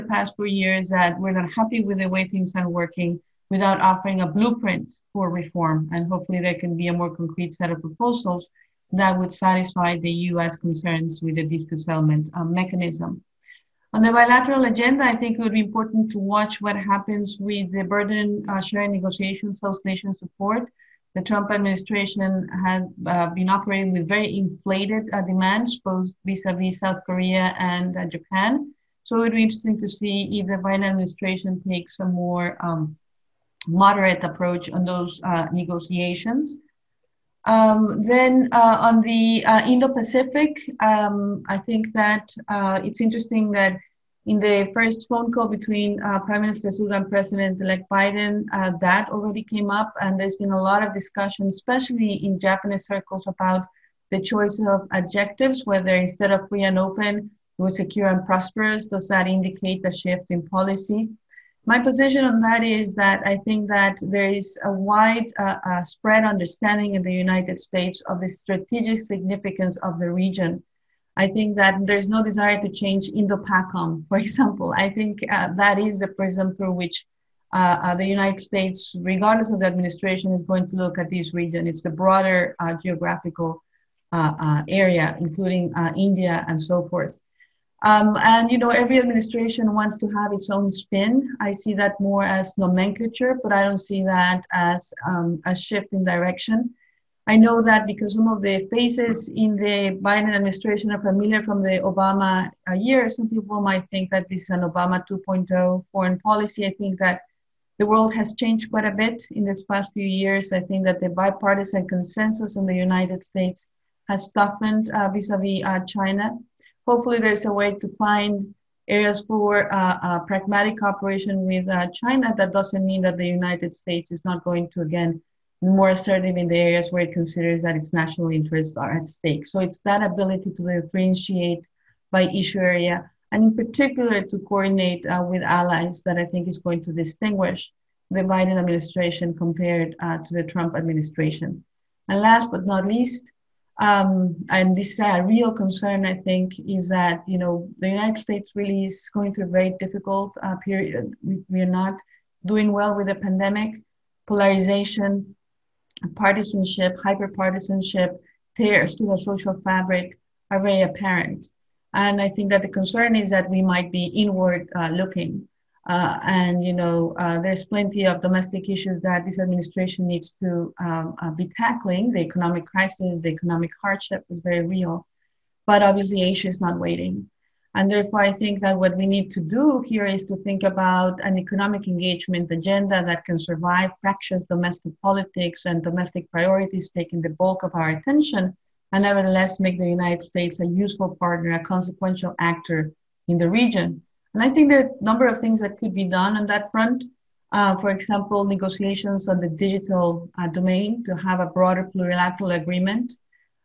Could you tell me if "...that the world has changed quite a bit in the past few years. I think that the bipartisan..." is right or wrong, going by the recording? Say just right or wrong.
right.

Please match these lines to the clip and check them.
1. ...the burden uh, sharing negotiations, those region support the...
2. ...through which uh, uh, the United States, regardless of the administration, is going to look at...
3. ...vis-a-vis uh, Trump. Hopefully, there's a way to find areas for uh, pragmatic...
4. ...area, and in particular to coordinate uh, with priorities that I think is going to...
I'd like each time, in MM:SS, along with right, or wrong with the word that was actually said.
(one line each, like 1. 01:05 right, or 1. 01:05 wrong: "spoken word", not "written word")
1. 00:17 wrong: "nation", not "region"
2. 01:16 right
3. 01:55 wrong: "China", not "Trump"
4. 02:12 wrong: "allies", not "priorities".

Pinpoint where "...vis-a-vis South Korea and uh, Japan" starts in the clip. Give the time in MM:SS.
00:26.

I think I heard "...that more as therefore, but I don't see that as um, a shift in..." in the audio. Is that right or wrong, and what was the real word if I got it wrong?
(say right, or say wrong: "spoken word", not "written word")
wrong: "nomenclature", not "therefore".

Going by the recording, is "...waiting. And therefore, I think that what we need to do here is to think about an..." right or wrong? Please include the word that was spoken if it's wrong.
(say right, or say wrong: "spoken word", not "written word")
right.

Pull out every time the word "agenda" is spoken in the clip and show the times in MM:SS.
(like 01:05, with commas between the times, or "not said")
00:14, 03:02.